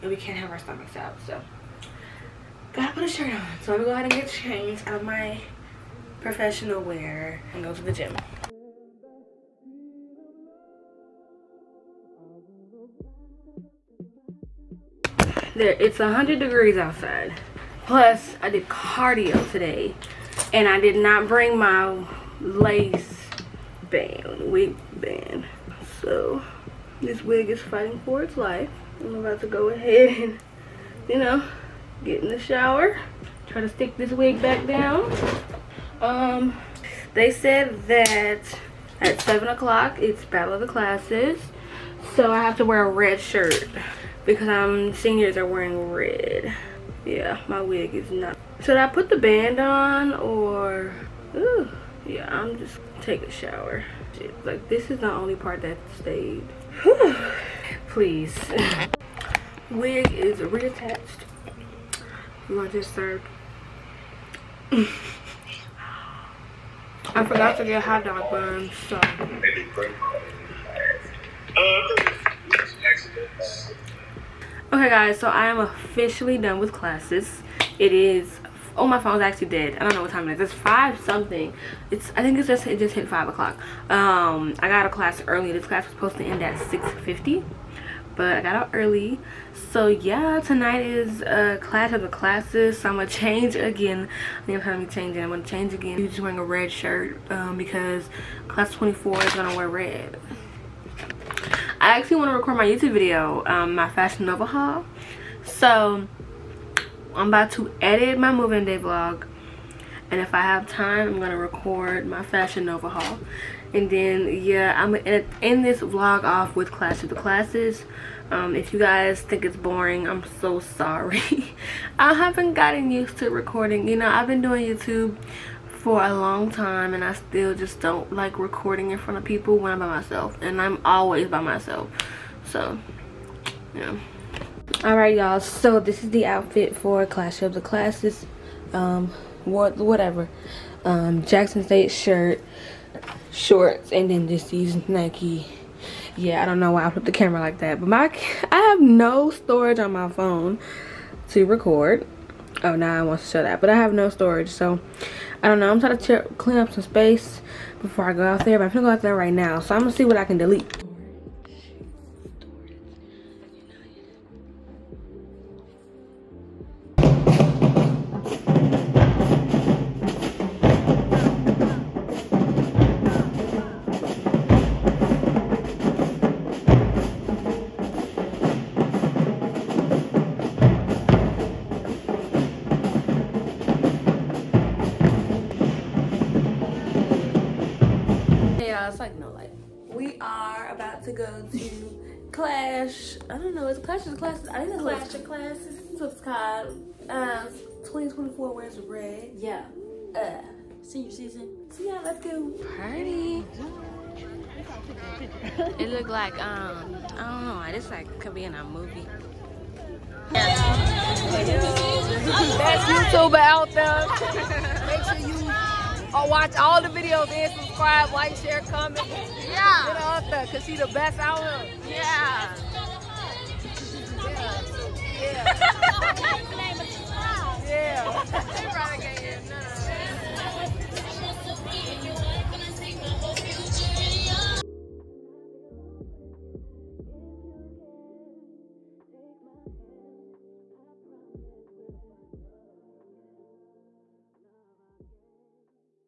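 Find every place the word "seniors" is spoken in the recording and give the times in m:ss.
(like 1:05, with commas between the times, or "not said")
0:44, 3:20.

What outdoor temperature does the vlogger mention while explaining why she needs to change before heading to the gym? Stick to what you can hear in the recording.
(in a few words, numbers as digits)
100 degrees.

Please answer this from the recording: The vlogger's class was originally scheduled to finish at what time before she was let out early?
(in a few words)
6:50.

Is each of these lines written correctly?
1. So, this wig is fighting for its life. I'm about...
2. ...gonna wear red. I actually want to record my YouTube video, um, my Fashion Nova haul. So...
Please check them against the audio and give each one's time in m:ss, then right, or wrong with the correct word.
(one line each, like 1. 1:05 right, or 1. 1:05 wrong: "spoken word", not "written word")
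1. 0:26 right
2. 1:39 right.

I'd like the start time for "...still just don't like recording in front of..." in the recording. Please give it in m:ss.
2:07.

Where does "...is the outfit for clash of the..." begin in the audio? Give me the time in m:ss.
2:16.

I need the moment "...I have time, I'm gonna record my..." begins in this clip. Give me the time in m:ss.
1:50.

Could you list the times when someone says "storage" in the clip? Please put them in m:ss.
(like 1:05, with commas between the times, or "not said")
2:29, 2:34.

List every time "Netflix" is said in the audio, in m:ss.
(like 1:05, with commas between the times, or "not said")
not said.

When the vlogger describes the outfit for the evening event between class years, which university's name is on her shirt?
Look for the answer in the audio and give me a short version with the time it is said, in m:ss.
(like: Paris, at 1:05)
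Jackson State, at 2:21.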